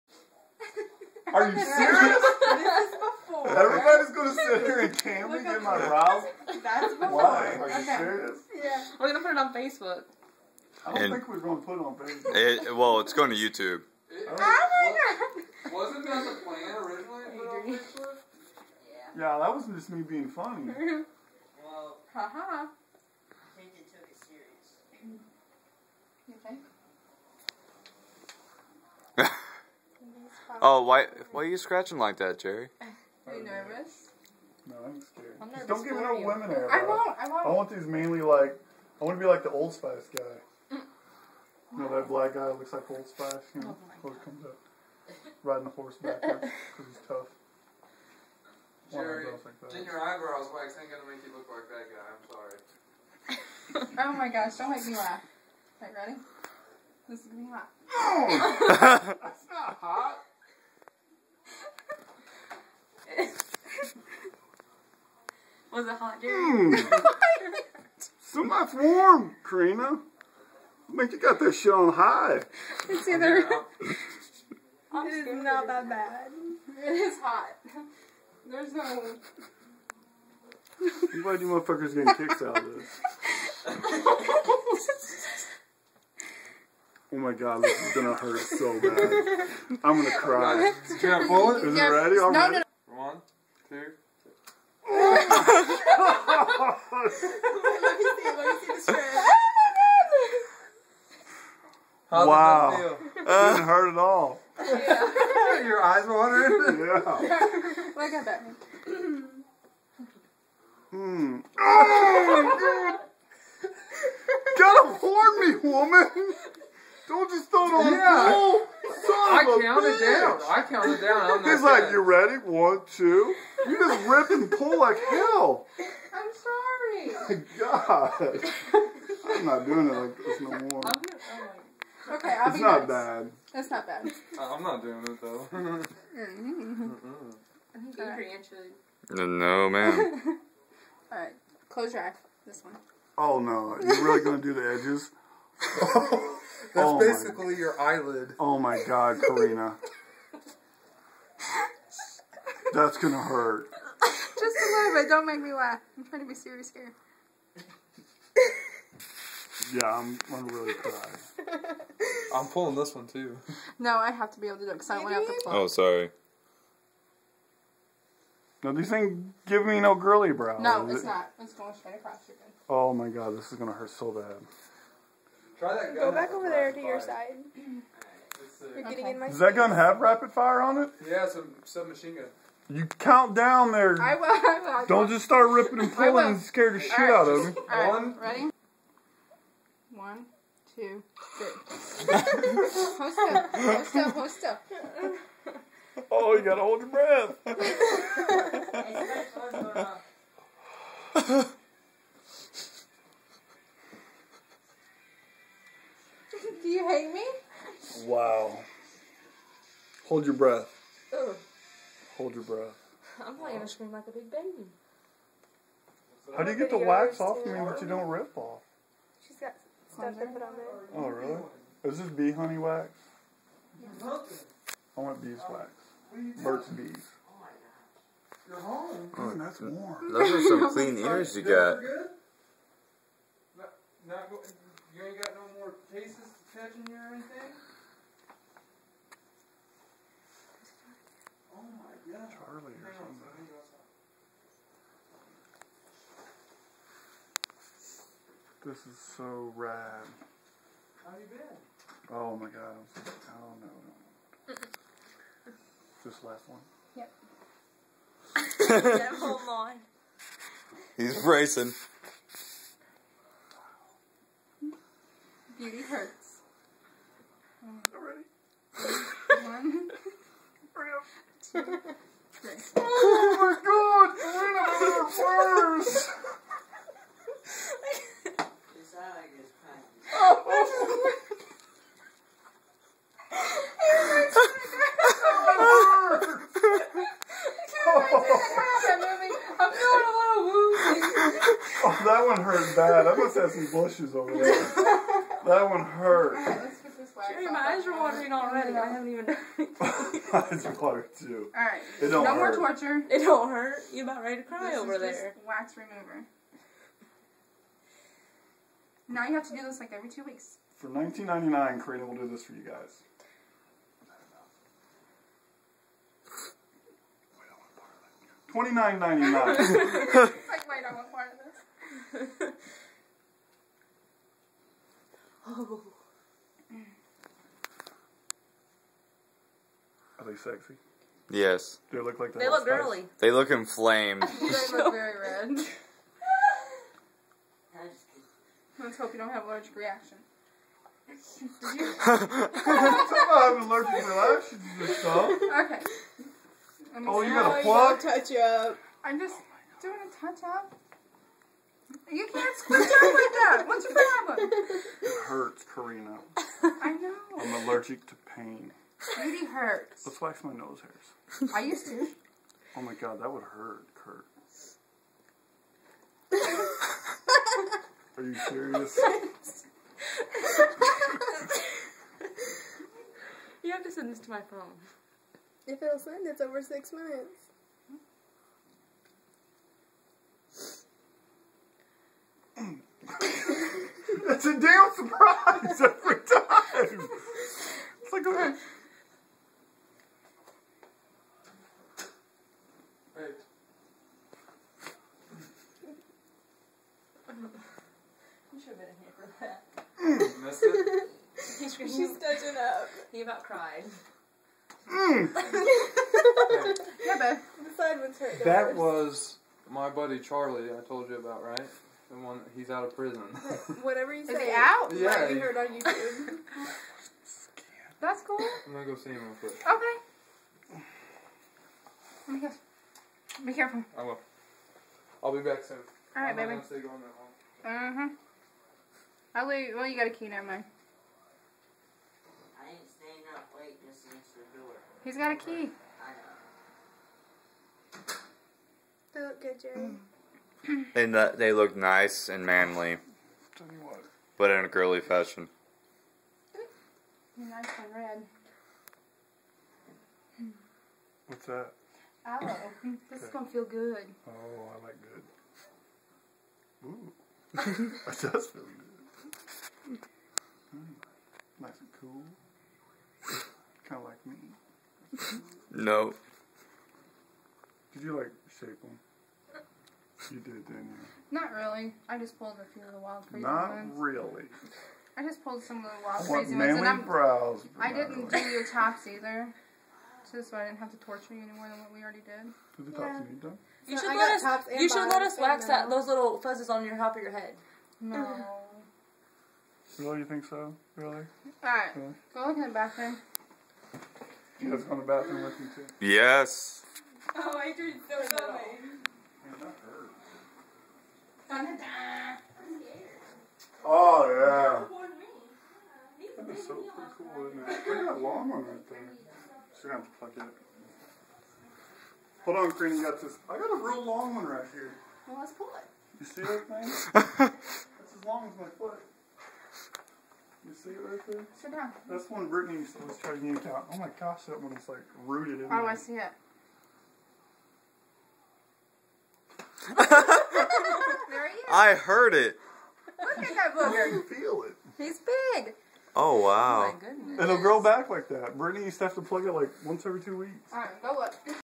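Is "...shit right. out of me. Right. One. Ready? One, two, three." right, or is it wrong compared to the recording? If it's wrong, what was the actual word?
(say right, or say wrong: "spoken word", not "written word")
right.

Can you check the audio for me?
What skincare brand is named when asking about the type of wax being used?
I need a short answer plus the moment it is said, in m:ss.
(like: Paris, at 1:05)
Burt's Bees, at 3:46.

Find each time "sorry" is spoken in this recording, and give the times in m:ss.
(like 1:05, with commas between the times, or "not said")
0:53, 2:07, 2:45.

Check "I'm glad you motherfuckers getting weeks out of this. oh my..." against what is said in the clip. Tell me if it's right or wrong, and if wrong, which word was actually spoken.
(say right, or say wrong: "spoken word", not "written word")
wrong: "kicks", not "weeks".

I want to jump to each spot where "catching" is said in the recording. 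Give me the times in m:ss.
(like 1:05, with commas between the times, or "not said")
3:56.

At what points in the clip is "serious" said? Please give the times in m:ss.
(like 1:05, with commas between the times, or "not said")
0:01, 0:07, 2:36, 6:08.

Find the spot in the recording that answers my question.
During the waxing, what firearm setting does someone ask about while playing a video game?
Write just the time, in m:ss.
2:59.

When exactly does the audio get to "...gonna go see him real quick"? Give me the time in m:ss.
6:58.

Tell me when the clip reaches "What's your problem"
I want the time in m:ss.
5:53.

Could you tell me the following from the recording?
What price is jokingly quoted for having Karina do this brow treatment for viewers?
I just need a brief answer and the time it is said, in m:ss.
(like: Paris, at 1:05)
$29.99, at 5:18.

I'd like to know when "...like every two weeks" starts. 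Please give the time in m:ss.
5:09.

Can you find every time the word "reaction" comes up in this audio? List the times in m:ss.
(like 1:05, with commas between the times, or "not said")
5:39, 5:43.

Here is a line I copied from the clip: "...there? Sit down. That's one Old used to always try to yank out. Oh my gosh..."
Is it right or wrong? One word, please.
wrong.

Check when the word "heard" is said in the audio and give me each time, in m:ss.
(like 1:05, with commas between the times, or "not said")
6:55, 8:51.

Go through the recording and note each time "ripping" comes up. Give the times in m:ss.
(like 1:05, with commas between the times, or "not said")
3:05.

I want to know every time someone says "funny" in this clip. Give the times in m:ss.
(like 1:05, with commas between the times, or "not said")
0:20, 8:18.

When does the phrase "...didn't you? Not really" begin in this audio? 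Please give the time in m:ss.
7:50.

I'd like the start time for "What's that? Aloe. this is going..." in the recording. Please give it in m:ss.
7:31.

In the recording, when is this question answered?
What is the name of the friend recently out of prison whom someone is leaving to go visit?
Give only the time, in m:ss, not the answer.
6:50.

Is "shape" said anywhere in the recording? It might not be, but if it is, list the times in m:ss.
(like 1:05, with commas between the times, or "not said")
7:48.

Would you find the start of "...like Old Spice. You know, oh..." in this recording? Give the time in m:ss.
0:42.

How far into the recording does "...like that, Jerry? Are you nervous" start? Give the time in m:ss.
0:31.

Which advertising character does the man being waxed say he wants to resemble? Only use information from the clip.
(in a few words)
Old Spice guy.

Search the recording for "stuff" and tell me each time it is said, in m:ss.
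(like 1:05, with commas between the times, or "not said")
3:39, 5:44.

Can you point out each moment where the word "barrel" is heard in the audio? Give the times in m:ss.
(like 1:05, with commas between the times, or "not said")
not said.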